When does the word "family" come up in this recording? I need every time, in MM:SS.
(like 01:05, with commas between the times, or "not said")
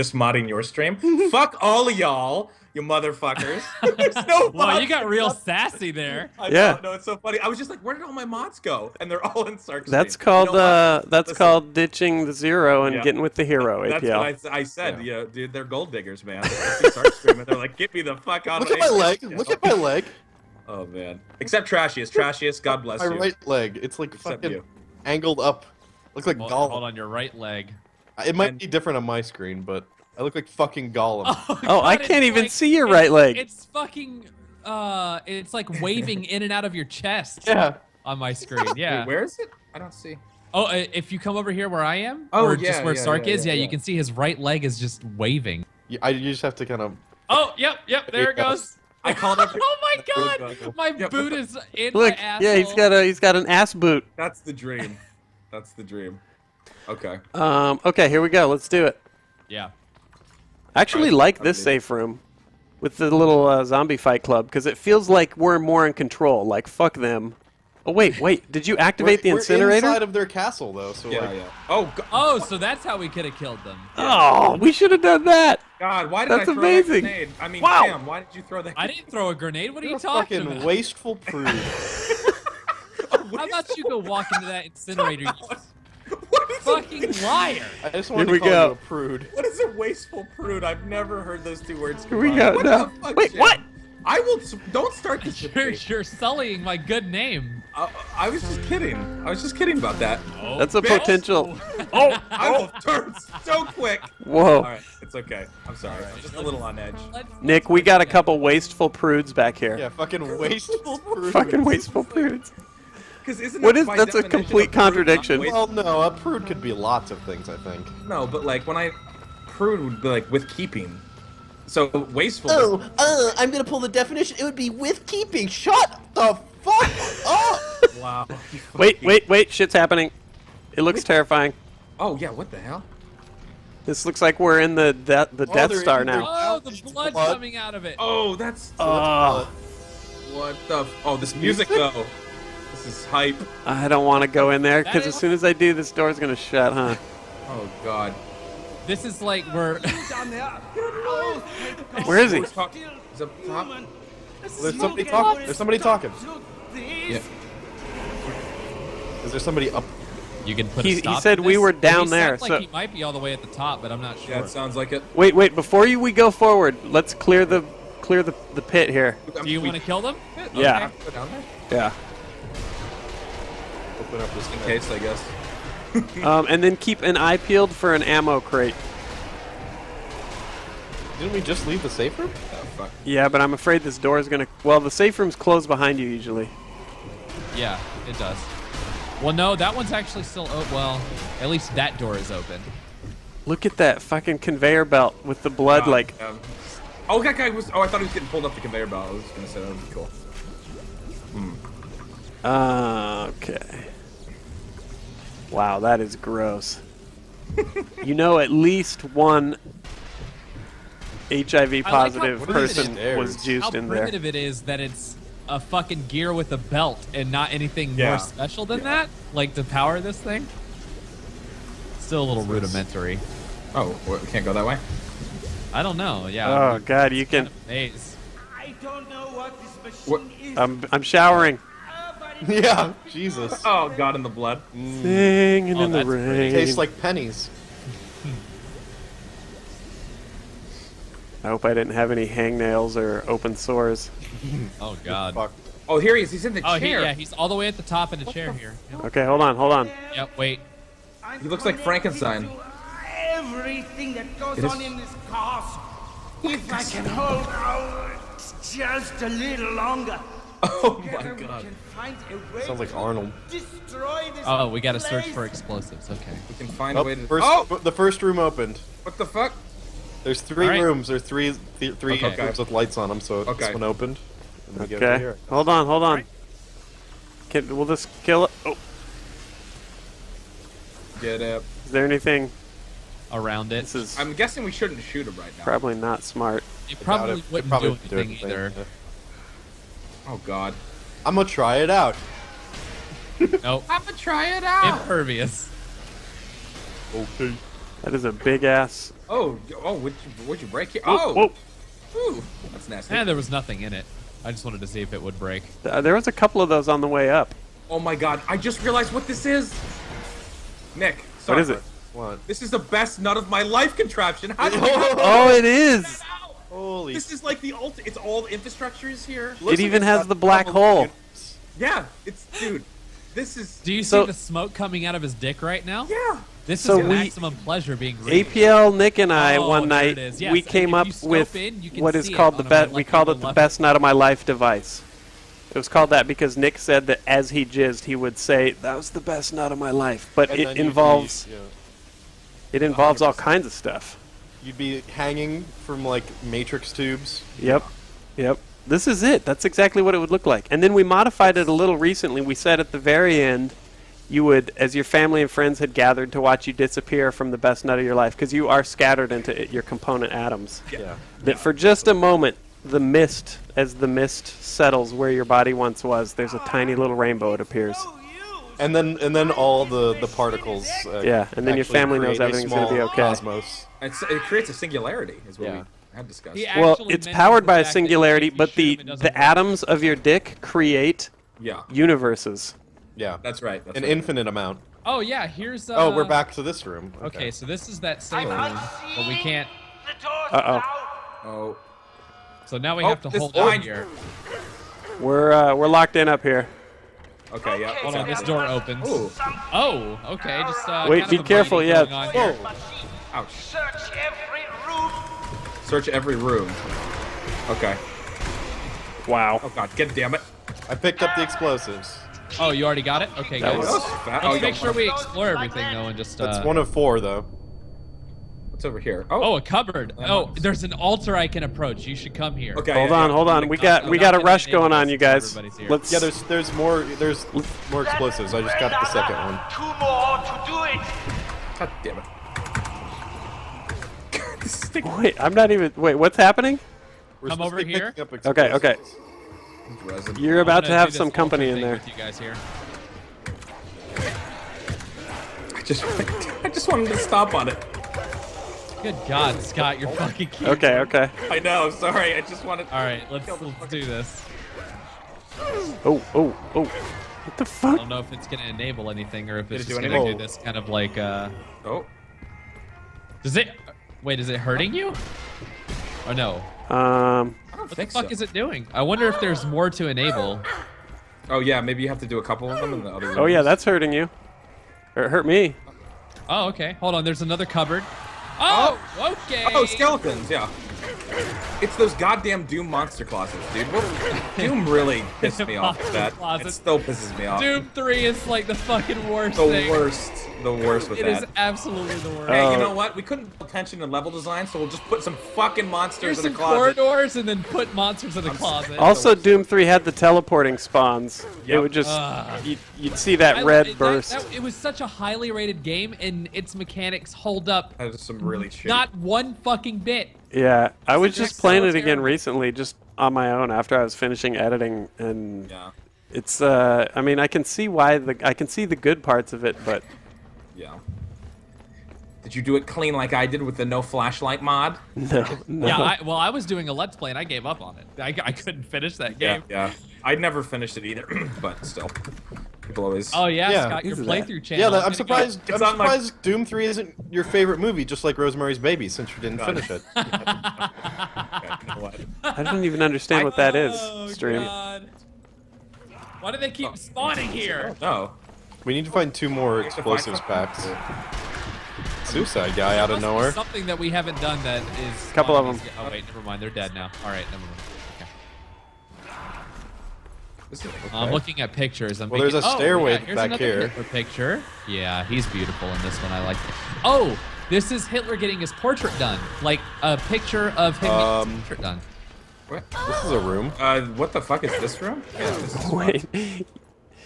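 05:55, 06:11.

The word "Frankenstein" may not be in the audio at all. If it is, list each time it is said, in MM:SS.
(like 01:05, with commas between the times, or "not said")
04:11.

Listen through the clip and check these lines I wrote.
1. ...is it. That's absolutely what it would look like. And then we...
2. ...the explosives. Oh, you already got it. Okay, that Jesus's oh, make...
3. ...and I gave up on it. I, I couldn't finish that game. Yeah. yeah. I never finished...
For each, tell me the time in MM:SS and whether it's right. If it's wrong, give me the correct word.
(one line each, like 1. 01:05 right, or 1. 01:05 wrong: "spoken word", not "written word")
1. 05:49 wrong: "exactly", not "absolutely"
2. 06:51 wrong: "Let", not "Jesus"
3. 08:47 right.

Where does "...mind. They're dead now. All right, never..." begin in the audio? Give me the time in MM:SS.
09:16.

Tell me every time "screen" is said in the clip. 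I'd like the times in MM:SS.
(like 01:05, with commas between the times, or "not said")
00:29, 00:38.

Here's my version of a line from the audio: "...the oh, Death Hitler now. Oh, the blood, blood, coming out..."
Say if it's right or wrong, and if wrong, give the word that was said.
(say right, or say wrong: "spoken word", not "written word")
wrong: "Star", not "Hitler".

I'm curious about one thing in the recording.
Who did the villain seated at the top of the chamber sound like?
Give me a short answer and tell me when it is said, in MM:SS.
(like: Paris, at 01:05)
Arnold, at 04:22.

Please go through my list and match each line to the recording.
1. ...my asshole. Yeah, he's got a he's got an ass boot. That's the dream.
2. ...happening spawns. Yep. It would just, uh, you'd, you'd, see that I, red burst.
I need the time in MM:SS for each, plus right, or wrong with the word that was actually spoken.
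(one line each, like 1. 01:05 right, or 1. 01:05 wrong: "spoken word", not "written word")
1. 00:52 right
2. 08:20 wrong: "teleporting", not "happening".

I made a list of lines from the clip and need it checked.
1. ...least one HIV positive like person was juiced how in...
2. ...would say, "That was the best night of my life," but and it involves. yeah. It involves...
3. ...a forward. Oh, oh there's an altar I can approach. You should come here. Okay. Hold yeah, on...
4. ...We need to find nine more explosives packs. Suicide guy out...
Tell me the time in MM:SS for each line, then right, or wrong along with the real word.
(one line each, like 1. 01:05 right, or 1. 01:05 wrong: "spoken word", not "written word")
1. 03:28 right
2. 05:38 right
3. 06:59 wrong: "cupboard", not "forward"
4. 09:08 wrong: "two", not "nine".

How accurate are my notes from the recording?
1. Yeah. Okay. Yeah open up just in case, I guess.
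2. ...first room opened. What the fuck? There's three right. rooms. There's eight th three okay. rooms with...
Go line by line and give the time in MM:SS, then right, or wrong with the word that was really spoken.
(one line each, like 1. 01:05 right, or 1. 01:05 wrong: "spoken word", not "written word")
1. 02:50 right
2. 04:27 wrong: "three", not "eight".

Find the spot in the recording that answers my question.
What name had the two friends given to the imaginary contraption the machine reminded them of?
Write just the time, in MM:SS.
05:33.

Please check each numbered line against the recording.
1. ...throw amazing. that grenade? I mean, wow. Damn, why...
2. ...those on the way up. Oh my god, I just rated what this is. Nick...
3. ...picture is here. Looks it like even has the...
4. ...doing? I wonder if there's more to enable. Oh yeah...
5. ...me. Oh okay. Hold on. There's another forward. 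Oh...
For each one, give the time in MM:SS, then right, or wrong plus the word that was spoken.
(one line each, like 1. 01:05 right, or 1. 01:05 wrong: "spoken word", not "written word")
1. 01:16 right
2. 05:06 wrong: "realized", not "rated"
3. 05:18 wrong: "infrastructure", not "picture"
4. 07:48 right
5. 07:55 wrong: "cupboard", not "forward".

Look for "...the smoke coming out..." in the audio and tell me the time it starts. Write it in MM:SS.
05:24.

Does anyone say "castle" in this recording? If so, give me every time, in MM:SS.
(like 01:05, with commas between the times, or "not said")
01:10, 04:15.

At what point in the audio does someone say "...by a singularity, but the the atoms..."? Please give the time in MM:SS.
06:17.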